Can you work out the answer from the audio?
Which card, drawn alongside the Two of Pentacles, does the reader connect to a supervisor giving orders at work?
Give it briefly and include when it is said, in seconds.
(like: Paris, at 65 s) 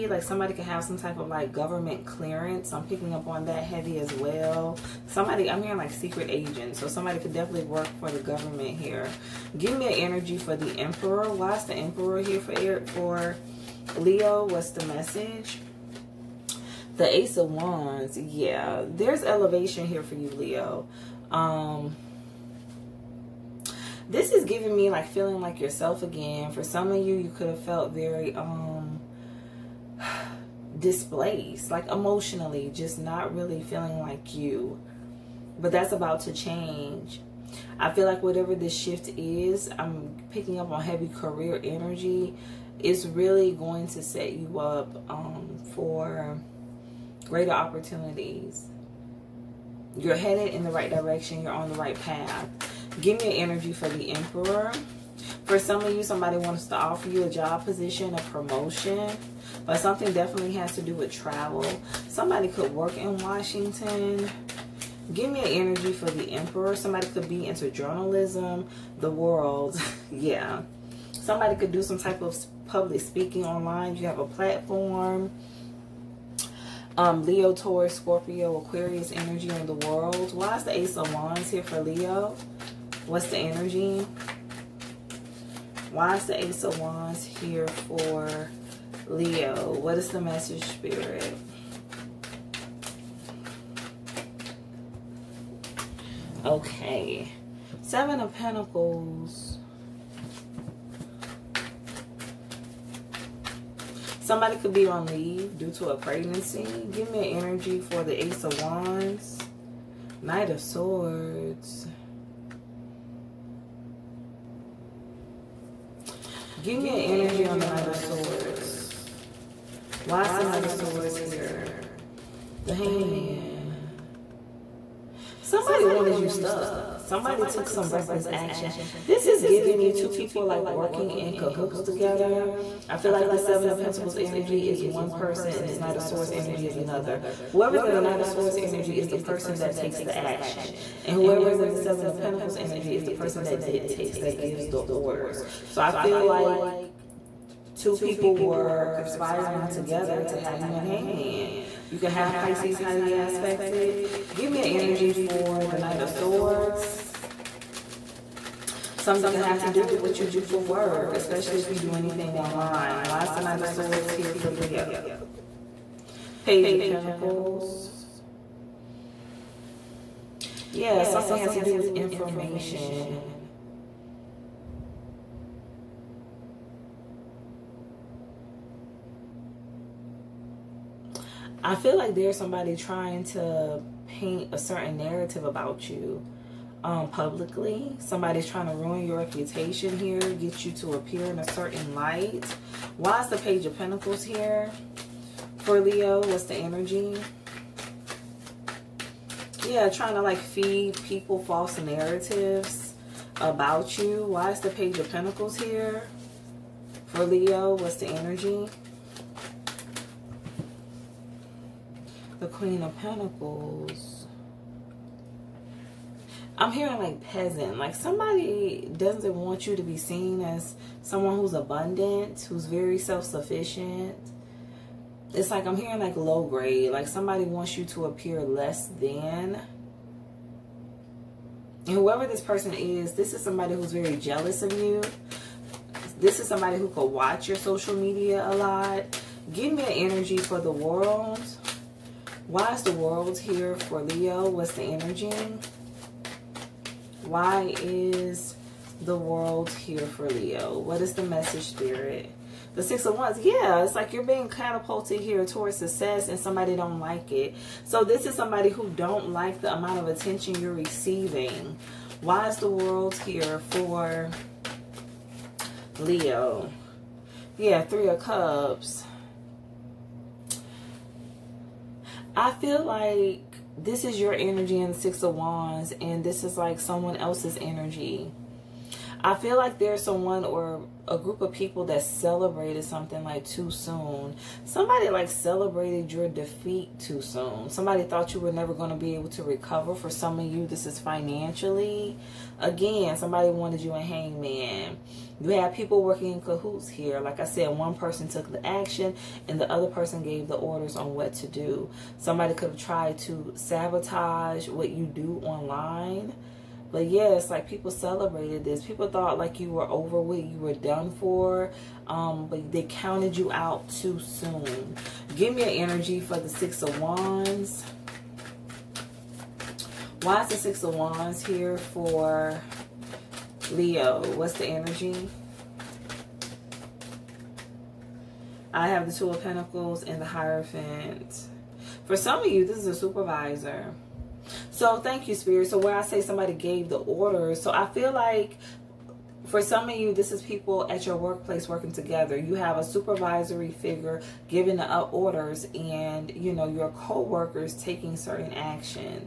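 The Hierophant, at 330 s.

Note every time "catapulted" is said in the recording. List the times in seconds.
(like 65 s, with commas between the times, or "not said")
254 s.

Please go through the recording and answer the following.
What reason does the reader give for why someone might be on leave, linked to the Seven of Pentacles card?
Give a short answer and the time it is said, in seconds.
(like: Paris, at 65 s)
A pregnancy, at 105 s.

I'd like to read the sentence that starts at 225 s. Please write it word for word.
It's like I'm hearing like low grade.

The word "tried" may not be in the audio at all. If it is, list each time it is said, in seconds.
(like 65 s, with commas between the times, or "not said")
302 s.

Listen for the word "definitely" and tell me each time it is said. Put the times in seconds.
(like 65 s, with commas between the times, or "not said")
7 s, 60 s.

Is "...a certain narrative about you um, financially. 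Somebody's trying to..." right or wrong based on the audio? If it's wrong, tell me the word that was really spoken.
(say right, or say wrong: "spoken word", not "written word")
wrong: "publicly", not "financially".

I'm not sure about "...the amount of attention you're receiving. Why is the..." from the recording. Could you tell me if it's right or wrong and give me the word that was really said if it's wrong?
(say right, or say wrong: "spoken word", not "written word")
right.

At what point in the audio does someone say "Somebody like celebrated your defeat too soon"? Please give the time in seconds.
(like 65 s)
284 s.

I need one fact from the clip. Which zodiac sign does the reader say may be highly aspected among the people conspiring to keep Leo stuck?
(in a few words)
Pisces.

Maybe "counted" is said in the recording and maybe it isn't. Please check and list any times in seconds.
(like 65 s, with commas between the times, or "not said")
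312 s.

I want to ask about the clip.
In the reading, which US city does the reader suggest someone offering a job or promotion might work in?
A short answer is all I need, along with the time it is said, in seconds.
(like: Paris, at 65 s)
Washington, at 63 s.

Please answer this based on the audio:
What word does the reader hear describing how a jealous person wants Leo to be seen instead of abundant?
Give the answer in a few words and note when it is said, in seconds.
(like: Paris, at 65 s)
Peasant, at 217 s.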